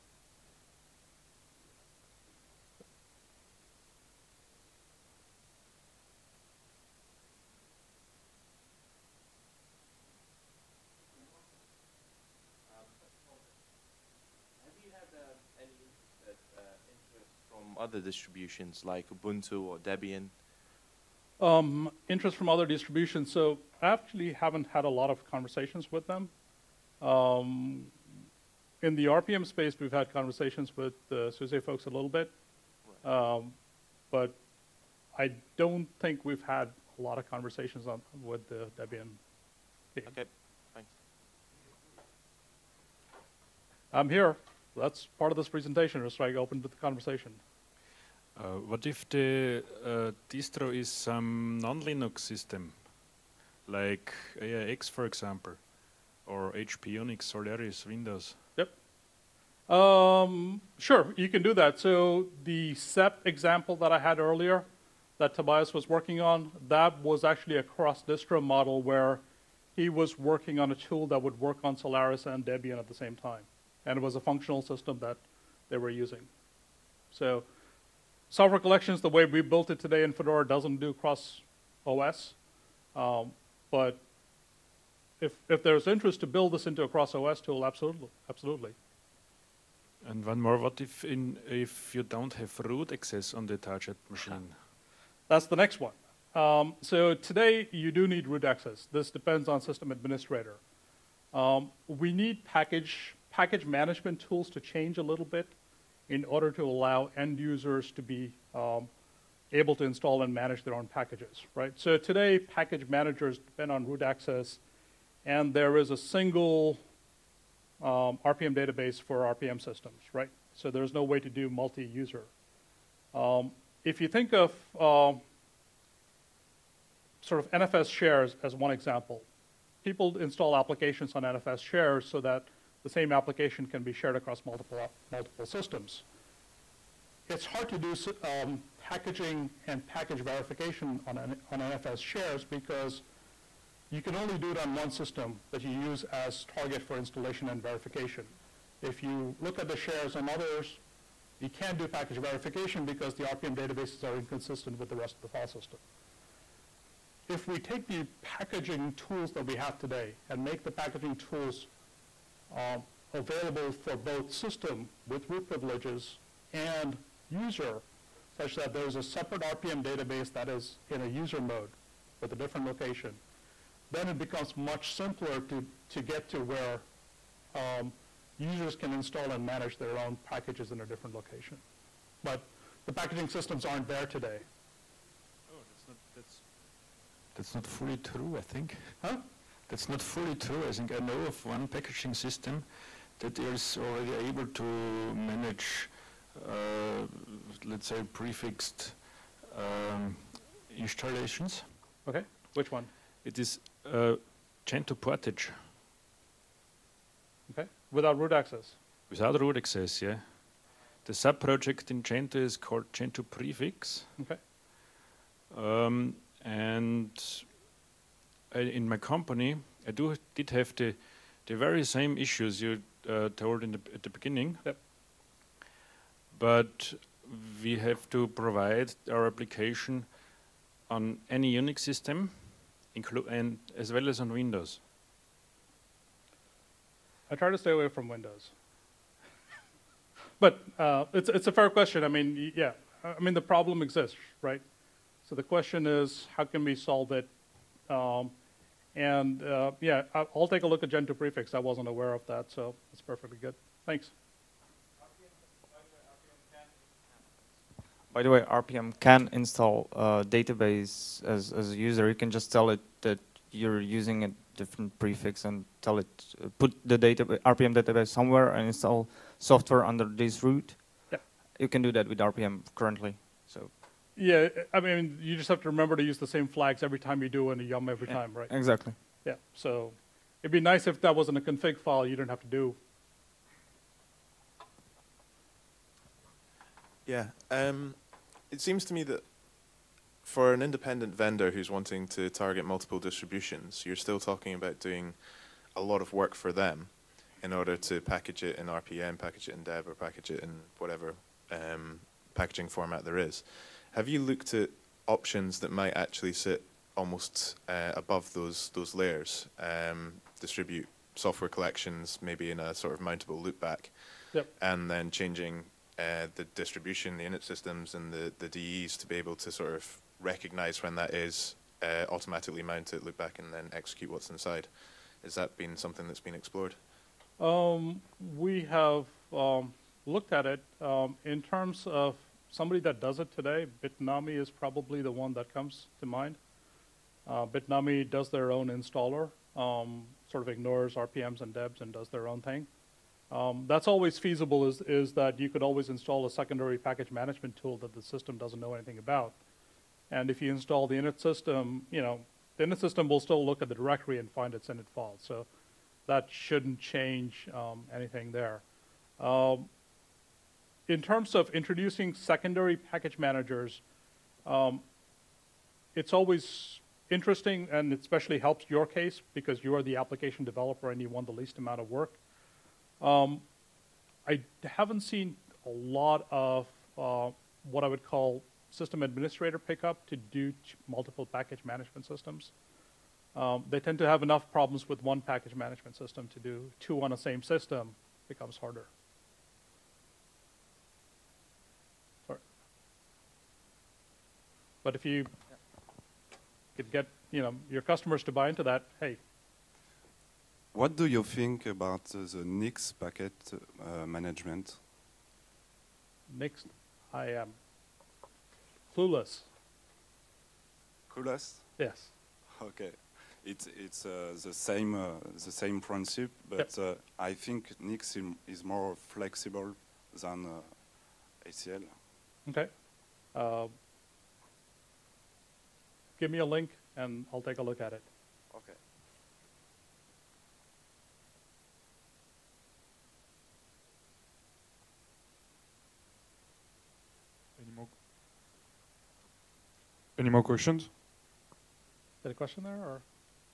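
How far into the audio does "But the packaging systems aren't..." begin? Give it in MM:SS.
03:02.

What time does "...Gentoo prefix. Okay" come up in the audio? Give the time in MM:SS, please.
03:32.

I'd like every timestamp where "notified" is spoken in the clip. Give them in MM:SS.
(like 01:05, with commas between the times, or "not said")
not said.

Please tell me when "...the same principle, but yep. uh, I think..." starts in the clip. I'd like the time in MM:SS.
06:55.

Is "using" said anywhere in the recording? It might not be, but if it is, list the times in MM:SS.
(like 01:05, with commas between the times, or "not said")
01:15, 04:23.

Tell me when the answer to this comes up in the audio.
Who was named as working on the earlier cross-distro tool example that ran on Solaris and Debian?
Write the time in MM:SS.
01:05.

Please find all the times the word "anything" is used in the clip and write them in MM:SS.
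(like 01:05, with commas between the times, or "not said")
05:48, 05:57.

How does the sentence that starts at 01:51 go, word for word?
So today, package managers depend on root access and there is a single um, RPM database for RPM systems, right?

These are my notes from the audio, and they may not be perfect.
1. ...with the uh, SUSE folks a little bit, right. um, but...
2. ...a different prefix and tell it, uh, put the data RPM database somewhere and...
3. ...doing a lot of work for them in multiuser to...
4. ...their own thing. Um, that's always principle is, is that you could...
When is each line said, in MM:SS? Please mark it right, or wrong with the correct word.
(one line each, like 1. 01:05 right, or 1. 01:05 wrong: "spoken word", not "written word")
1. 00:30 right
2. 04:24 right
3. 04:54 wrong: "order", not "multiuser"
4. 05:42 wrong: "feasible", not "principle".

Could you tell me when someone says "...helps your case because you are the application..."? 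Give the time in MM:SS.
06:08.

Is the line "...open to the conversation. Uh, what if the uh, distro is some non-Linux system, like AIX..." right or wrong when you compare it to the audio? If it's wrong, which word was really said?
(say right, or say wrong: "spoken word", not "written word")
right.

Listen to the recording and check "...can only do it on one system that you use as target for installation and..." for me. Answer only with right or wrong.
right.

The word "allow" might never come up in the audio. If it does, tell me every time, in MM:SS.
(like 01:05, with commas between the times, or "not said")
01:46.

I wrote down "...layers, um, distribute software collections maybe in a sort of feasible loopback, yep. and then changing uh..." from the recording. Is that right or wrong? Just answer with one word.
wrong.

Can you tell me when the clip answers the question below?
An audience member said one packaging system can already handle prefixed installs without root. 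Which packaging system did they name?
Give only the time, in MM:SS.
03:25.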